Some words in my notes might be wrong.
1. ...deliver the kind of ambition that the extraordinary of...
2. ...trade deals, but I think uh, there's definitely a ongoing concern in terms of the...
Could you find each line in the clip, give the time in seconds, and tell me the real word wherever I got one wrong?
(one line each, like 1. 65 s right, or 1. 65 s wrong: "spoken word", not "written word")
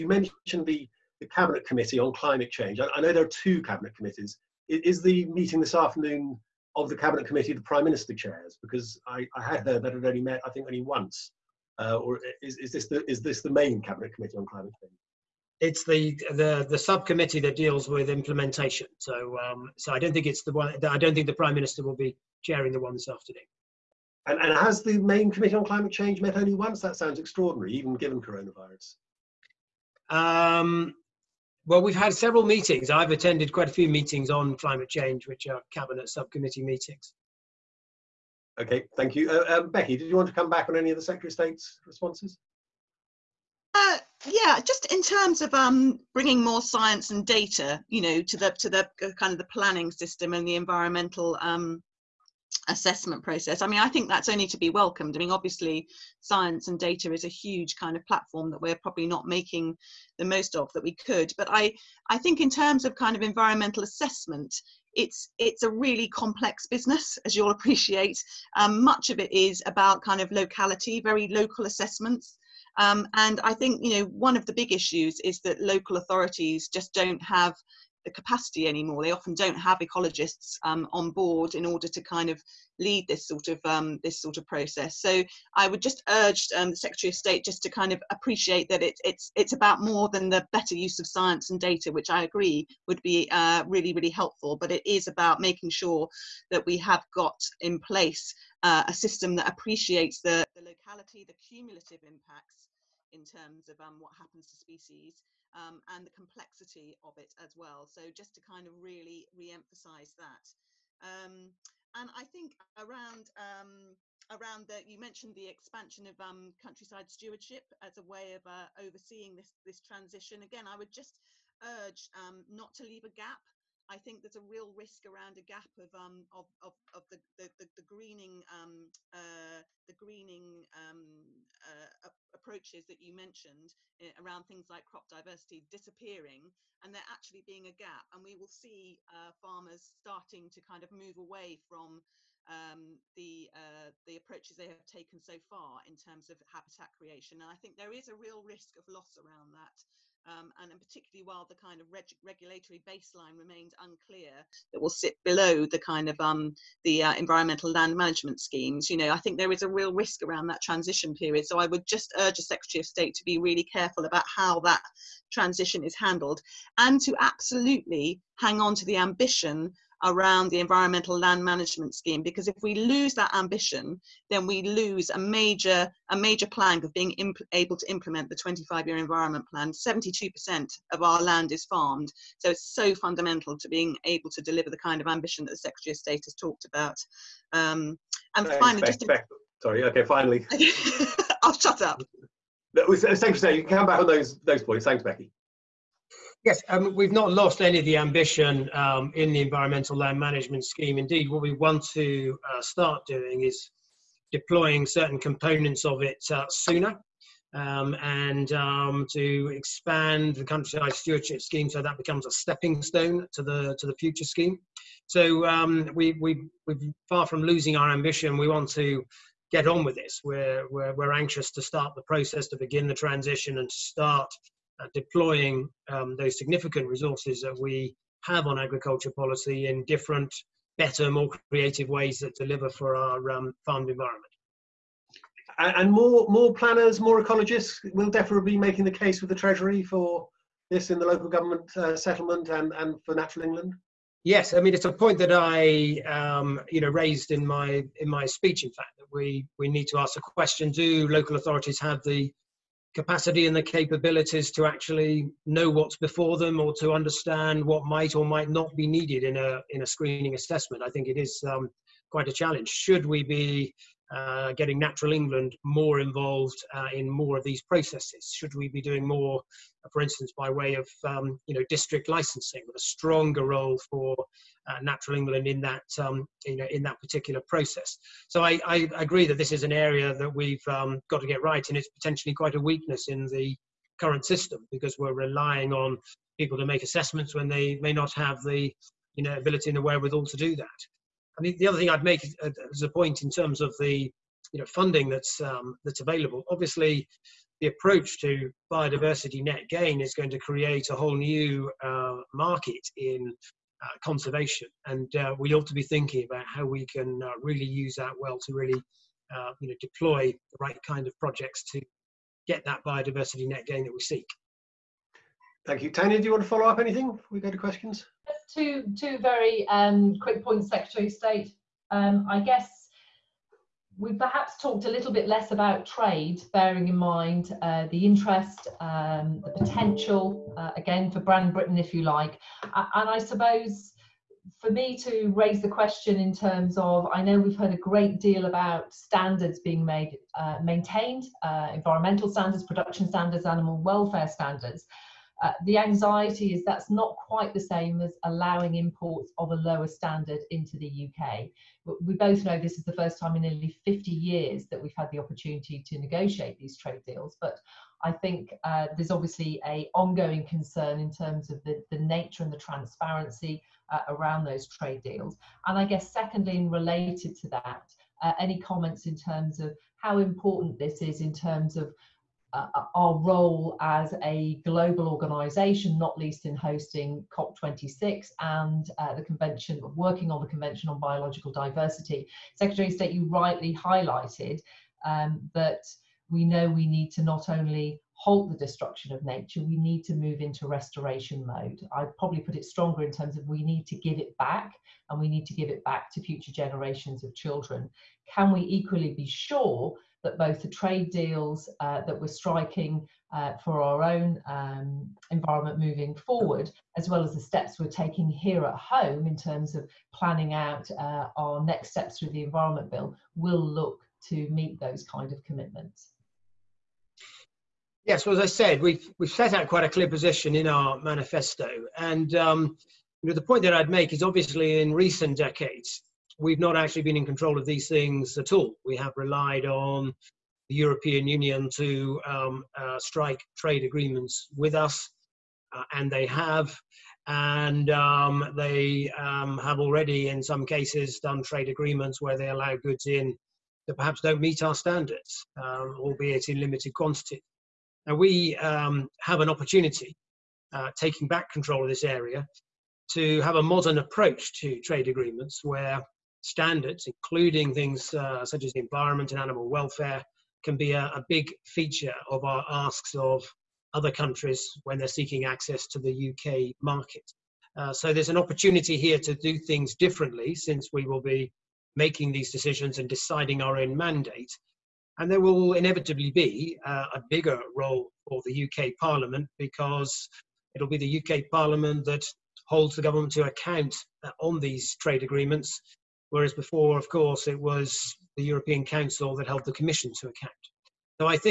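1. 184 s wrong: "secretary", not "extraordinary"
2. 356 s wrong: "obviously", not "definitely".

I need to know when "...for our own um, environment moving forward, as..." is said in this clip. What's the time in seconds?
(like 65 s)
403 s.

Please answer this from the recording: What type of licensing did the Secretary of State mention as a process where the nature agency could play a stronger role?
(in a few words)
district licensing.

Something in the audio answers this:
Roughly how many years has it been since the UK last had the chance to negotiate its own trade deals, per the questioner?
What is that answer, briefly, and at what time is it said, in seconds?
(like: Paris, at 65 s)
nearly 50 years, at 353 s.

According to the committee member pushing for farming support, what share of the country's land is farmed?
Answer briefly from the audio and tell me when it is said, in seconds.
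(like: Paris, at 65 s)
72%, at 179 s.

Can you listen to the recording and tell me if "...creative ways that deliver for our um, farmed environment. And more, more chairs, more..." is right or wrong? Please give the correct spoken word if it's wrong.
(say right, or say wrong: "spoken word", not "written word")
wrong: "planners", not "chairs".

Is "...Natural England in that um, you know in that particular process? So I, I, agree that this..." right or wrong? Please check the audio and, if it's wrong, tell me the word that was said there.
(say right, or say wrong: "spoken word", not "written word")
right.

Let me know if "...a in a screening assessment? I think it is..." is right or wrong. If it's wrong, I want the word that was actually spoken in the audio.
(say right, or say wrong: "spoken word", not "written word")
right.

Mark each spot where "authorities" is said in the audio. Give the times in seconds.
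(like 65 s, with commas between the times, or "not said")
75 s, 251 s.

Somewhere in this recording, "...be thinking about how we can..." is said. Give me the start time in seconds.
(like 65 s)
305 s.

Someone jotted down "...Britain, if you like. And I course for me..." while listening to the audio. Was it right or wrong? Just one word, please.
wrong.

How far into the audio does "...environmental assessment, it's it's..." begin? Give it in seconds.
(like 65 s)
63 s.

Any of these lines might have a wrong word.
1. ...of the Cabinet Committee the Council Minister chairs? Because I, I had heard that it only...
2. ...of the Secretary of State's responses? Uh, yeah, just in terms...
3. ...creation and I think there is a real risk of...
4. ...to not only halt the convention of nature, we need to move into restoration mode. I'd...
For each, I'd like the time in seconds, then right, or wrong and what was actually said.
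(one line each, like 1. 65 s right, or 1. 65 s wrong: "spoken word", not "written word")
1. 6 s wrong: "Prime", not "Council"
2. 40 s right
3. 146 s right
4. 387 s wrong: "destruction", not "convention".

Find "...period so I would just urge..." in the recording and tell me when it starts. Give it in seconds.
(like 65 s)
161 s.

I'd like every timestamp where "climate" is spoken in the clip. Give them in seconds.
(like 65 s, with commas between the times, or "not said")
2 s, 14 s, 25 s, 34 s.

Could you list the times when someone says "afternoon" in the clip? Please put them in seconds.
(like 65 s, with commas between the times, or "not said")
5 s, 23 s.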